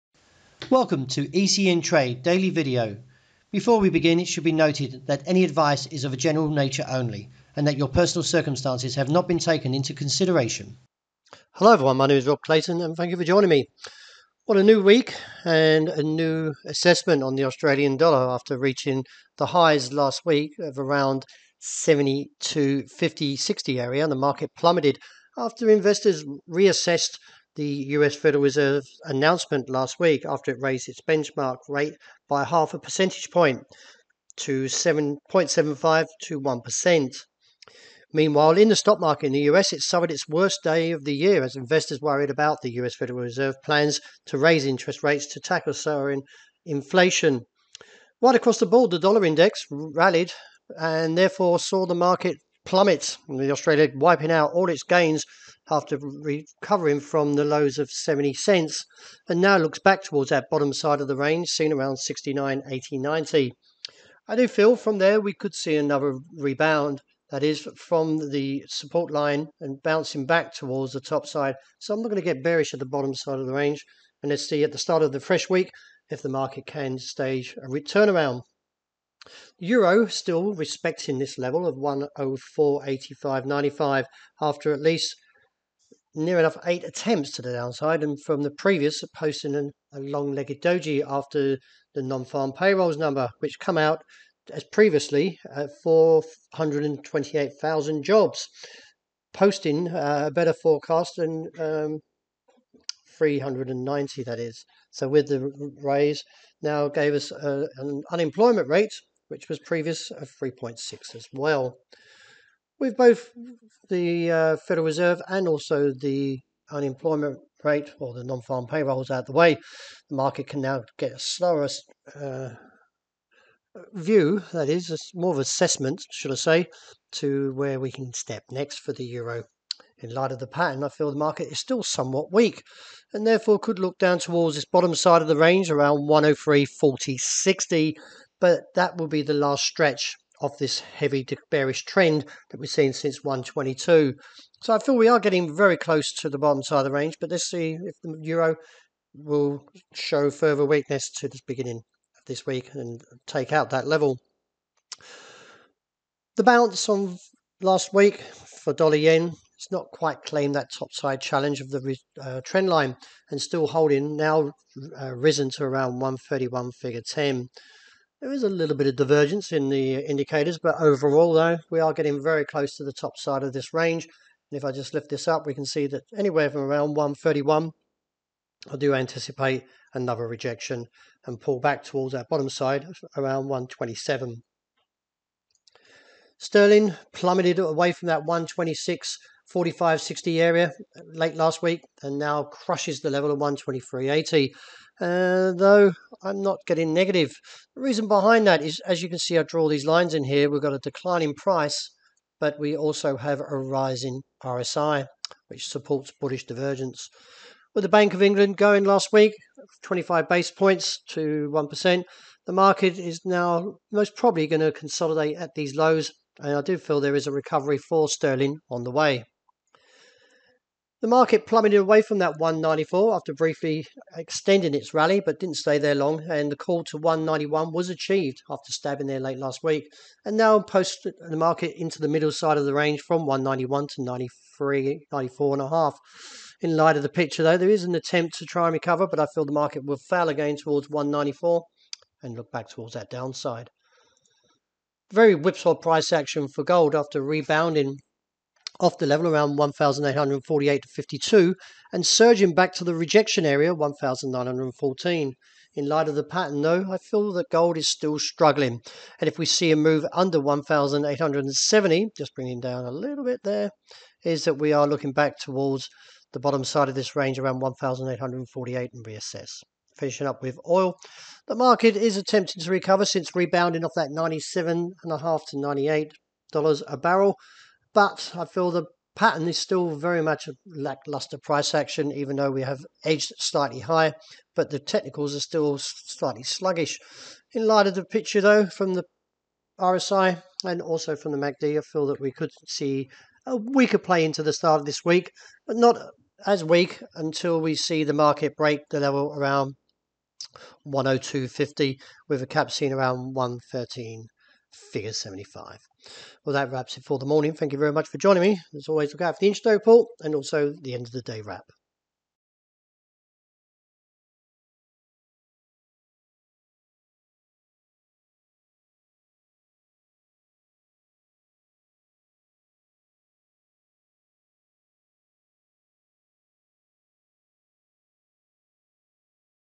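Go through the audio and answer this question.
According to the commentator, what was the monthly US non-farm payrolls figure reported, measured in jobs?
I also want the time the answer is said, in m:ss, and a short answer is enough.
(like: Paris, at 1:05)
428,000, at 1:35.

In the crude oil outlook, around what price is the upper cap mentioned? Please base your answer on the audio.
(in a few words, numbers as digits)
113.75.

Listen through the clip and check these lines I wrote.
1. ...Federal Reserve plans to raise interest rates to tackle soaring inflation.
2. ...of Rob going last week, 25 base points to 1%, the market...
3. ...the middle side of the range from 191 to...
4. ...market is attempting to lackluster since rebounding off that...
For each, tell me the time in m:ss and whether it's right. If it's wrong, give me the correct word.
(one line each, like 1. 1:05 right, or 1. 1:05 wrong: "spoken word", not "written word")
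1. 0:42 right
2. 3:28 wrong: "England", not "Rob"
3. 3:51 right
4. 4:31 wrong: "recover", not "lackluster".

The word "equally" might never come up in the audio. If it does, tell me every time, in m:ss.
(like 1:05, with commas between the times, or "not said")
not said.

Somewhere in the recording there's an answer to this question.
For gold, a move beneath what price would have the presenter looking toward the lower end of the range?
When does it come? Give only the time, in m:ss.
4:20.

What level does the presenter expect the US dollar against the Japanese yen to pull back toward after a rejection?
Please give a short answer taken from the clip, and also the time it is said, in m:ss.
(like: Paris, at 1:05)
127, at 3:03.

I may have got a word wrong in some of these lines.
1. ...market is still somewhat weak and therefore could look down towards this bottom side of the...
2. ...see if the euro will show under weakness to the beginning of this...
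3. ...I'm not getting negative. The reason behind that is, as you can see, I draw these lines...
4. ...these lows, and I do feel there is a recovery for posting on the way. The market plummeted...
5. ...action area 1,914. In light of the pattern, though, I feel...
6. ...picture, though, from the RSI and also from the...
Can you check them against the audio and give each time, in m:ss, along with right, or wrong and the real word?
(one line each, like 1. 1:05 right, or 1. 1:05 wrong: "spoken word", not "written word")
1. 2:11 right
2. 2:27 wrong: "further", not "under"
3. 3:16 right
4. 3:35 wrong: "sterling", not "posting"
5. 4:12 wrong: "rejection", not "action"
6. 4:48 right.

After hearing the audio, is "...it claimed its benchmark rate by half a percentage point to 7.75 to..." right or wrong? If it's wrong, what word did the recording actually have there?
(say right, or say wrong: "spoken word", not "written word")
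wrong: "raised", not "claimed".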